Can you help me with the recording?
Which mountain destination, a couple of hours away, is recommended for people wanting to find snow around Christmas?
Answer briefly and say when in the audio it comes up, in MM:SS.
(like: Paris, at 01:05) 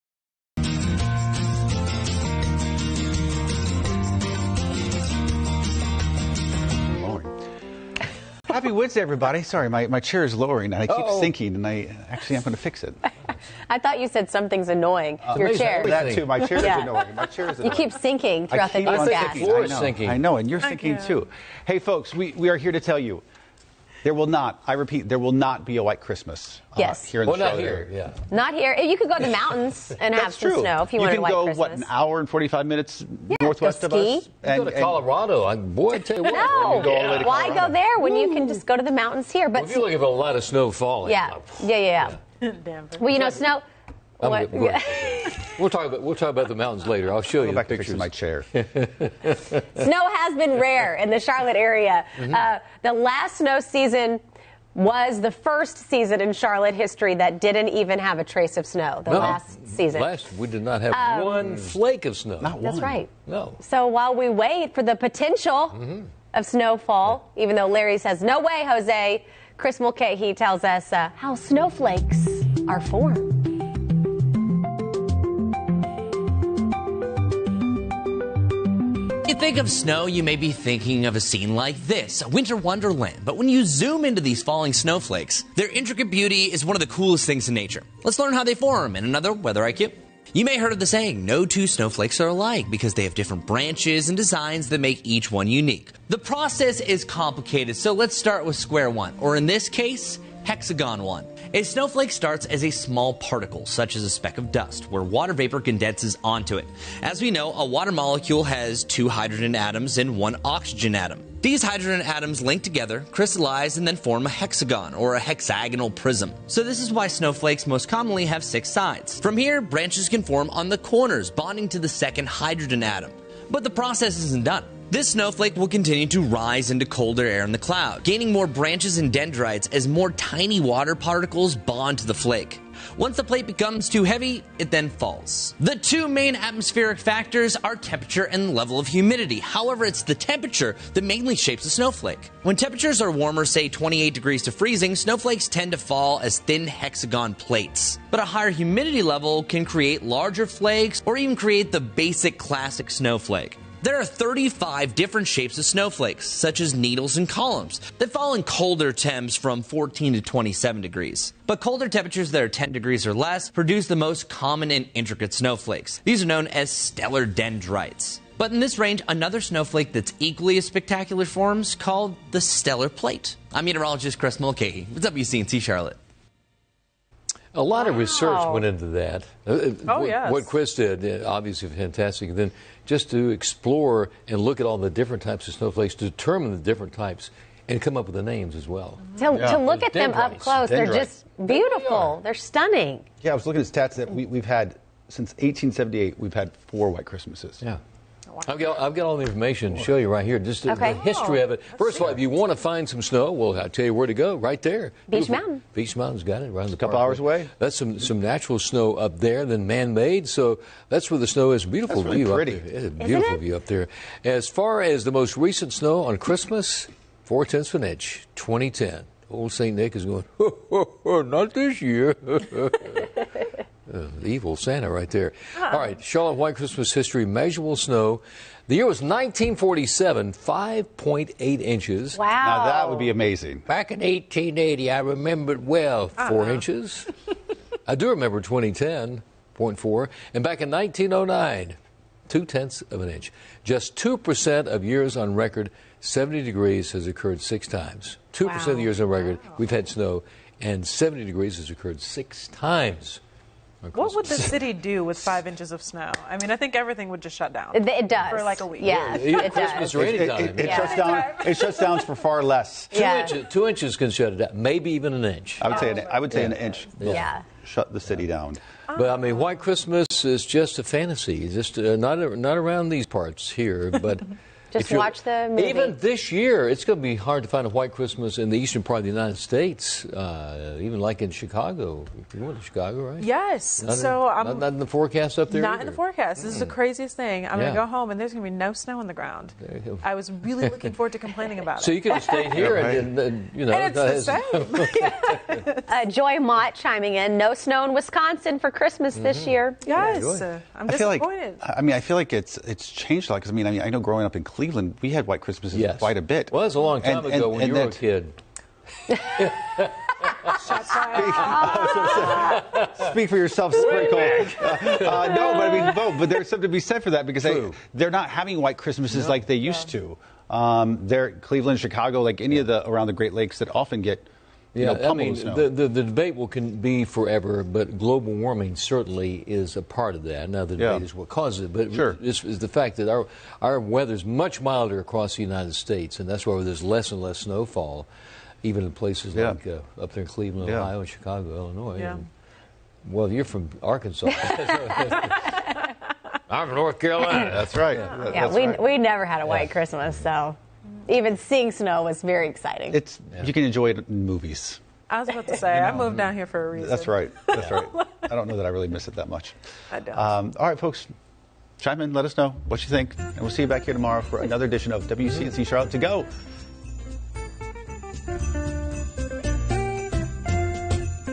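Beech Mountain, at 03:25.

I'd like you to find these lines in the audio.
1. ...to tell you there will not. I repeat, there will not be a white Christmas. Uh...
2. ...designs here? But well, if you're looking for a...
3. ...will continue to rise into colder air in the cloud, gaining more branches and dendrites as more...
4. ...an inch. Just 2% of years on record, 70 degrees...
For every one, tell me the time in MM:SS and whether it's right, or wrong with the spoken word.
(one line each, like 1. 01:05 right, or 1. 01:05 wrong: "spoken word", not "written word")
1. 00:22 right
2. 00:38 wrong: "mountains", not "designs"
3. 02:05 right
4. 04:03 right.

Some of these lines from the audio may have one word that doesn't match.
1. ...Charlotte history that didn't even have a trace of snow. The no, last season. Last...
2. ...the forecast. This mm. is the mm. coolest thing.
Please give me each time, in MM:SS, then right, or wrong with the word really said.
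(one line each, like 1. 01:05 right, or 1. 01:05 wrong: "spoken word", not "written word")
1. 00:56 right
2. 04:45 wrong: "craziest", not "coolest".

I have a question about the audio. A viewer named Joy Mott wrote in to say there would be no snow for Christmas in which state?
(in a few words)
Wisconsin.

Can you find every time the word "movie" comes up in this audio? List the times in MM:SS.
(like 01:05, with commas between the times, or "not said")
04:35, 05:54.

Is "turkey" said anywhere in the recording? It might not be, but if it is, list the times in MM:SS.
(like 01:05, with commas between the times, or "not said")
not said.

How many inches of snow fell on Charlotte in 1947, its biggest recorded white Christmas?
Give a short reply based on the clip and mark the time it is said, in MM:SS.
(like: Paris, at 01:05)
5.8 inches, at 03:50.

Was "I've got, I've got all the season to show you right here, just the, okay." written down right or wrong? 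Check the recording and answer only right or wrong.
wrong.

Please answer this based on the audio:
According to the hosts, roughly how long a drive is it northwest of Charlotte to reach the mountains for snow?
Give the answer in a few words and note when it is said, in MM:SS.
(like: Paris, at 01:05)
an hour and forty five minutes, at 00:31.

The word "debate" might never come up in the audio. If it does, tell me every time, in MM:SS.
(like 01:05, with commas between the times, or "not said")
05:26, 05:30.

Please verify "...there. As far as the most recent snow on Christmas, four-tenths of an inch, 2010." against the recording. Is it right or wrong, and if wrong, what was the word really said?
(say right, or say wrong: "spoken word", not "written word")
right.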